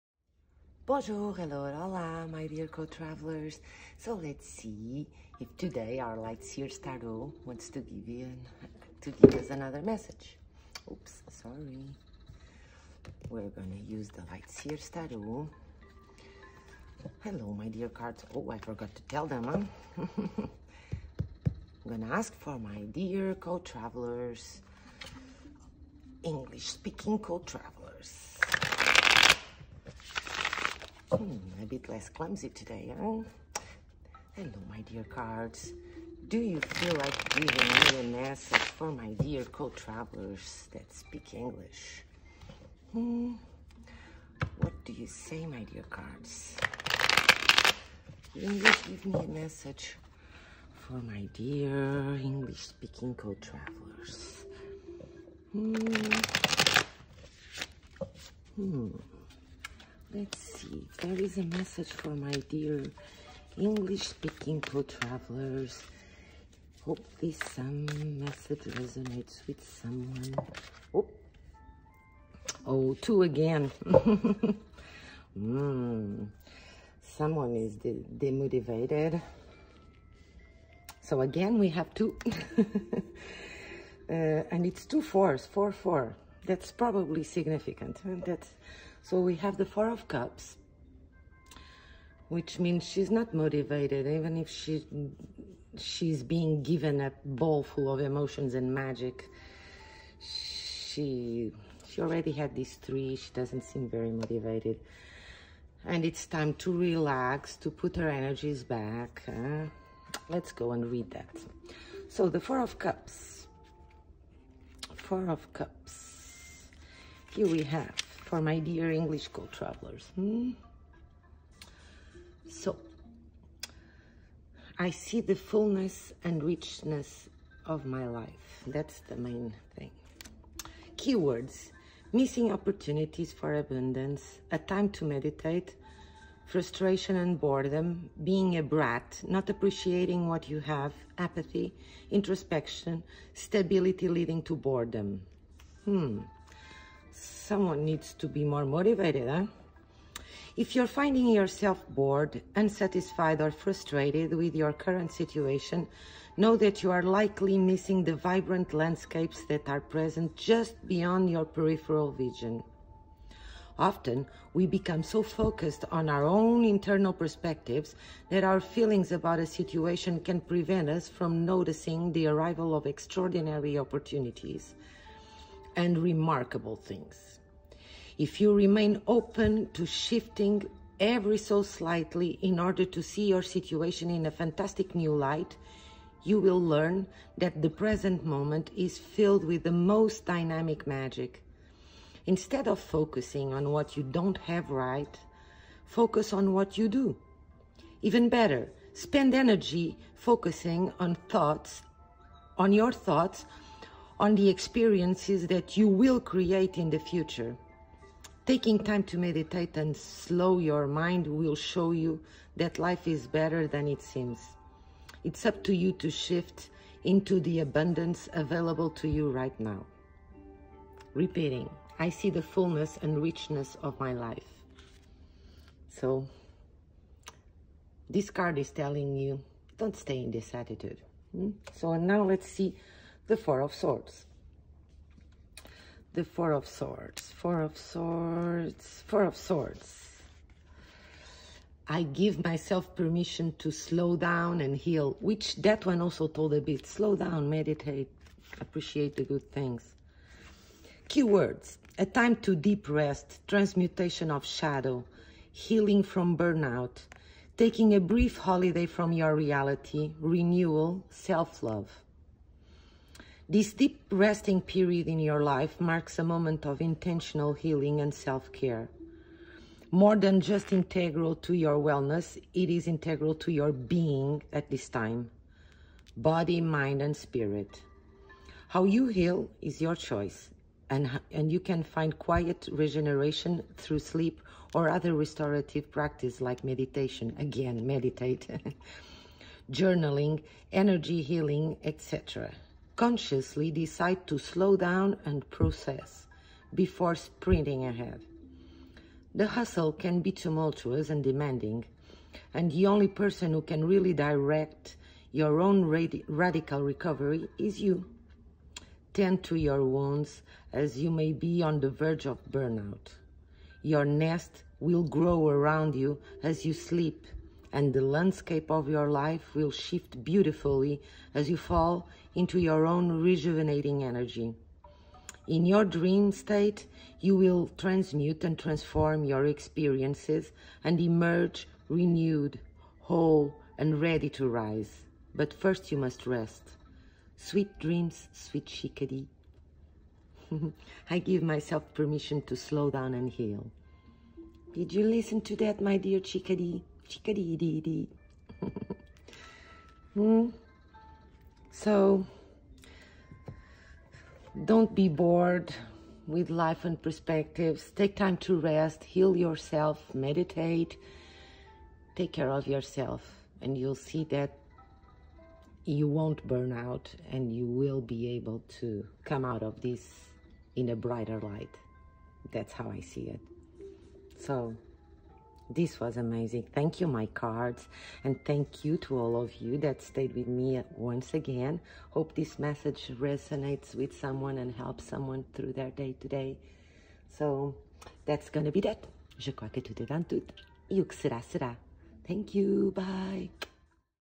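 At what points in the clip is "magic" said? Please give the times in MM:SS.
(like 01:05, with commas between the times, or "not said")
01:38, 03:10.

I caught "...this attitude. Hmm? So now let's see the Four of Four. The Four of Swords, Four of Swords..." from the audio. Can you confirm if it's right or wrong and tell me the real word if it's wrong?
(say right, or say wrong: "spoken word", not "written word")
wrong: "Swords", not "Four".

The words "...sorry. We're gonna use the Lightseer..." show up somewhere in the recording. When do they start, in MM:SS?
00:11.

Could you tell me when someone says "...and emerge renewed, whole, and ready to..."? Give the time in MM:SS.
05:30.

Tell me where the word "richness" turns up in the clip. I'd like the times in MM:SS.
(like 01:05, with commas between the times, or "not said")
02:06, 03:43.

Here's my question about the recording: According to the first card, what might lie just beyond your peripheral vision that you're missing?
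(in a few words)
vibrant landscapes.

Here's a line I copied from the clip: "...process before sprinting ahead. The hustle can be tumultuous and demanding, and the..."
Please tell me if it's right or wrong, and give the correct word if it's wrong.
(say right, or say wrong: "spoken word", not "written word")
right.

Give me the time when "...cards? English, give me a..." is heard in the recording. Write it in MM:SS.
00:45.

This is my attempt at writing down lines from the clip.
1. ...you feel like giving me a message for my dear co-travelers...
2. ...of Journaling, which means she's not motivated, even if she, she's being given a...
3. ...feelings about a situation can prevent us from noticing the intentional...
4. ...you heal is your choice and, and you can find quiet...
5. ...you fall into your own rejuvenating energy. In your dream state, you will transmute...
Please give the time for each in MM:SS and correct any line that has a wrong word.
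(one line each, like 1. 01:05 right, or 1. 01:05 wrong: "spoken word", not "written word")
1. 00:36 right
2. 01:29 wrong: "Cups", not "Journaling"
3. 02:48 wrong: "arrival", not "intentional"
4. 04:38 right
5. 05:21 right.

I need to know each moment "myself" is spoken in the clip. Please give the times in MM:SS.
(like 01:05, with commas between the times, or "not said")
04:02, 05:41.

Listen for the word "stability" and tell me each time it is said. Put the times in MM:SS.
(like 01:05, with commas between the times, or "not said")
02:23.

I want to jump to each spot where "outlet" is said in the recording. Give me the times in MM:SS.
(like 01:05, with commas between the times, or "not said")
not said.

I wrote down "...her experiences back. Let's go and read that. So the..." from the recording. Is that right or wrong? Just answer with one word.
wrong.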